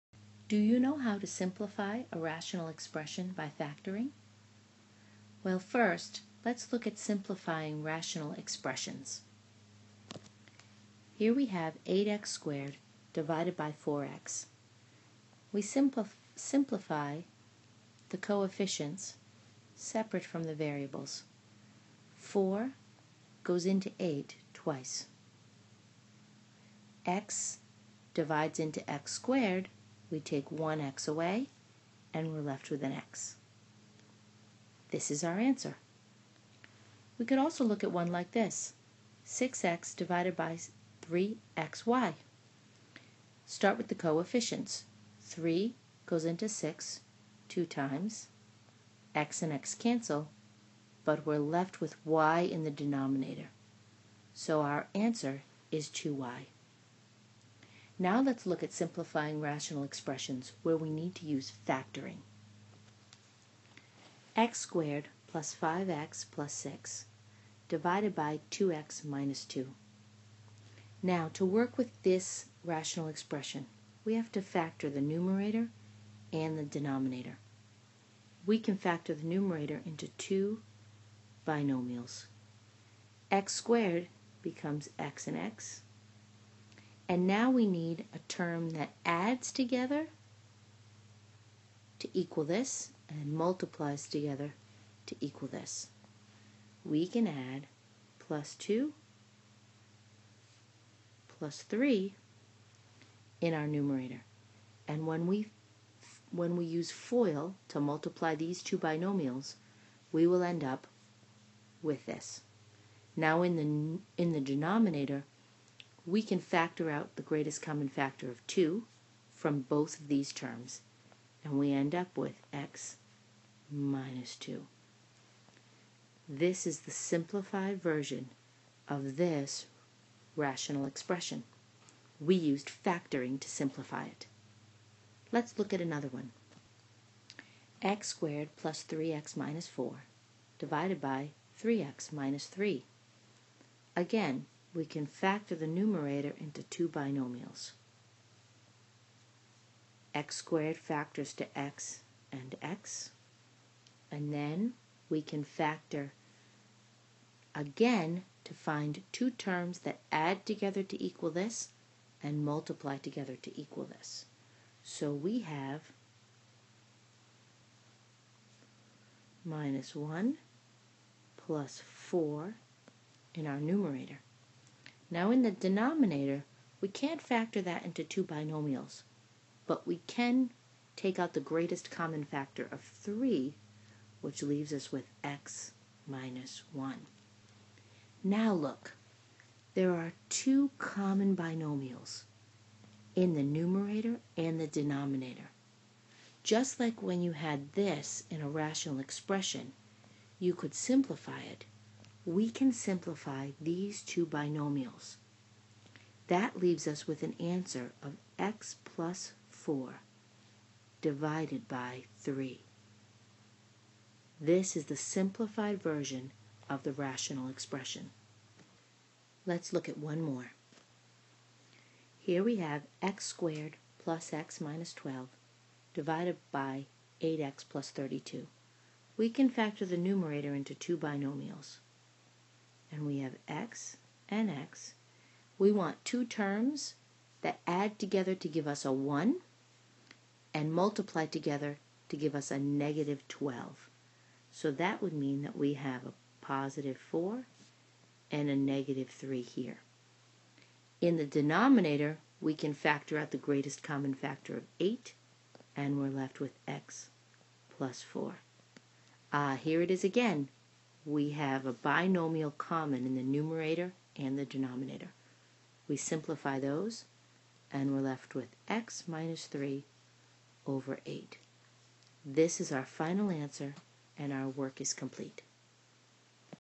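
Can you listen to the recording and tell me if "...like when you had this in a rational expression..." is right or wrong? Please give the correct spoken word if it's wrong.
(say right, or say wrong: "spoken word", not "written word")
right.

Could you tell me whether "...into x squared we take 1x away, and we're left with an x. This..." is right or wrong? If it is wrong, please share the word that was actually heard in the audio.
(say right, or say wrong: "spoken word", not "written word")
right.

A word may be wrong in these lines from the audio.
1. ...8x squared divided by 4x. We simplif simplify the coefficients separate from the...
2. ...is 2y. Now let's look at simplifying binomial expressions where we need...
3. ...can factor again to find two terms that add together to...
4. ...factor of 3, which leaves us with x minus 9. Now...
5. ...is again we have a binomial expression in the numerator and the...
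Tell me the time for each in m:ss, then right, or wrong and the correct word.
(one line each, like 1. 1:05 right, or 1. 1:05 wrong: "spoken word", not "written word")
1. 0:11 right
2. 0:55 wrong: "rational", not "binomial"
3. 2:35 right
4. 3:02 wrong: "1", not "9"
5. 4:19 wrong: "common", not "expression".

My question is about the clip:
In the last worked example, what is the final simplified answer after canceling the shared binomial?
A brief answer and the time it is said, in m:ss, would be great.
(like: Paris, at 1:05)
x - 3 over 8, at 4:28.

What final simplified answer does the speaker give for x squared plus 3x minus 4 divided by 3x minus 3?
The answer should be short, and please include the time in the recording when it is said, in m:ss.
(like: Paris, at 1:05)
x + 4 over 3, at 3:28.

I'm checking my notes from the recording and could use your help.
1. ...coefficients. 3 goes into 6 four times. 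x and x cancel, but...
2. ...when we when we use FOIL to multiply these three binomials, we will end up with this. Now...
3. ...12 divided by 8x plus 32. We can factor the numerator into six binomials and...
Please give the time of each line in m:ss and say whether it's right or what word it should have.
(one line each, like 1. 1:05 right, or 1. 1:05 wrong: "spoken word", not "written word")
1. 0:43 wrong: "two", not "four"
2. 1:45 wrong: "two", not "three"
3. 3:44 wrong: "two", not "six".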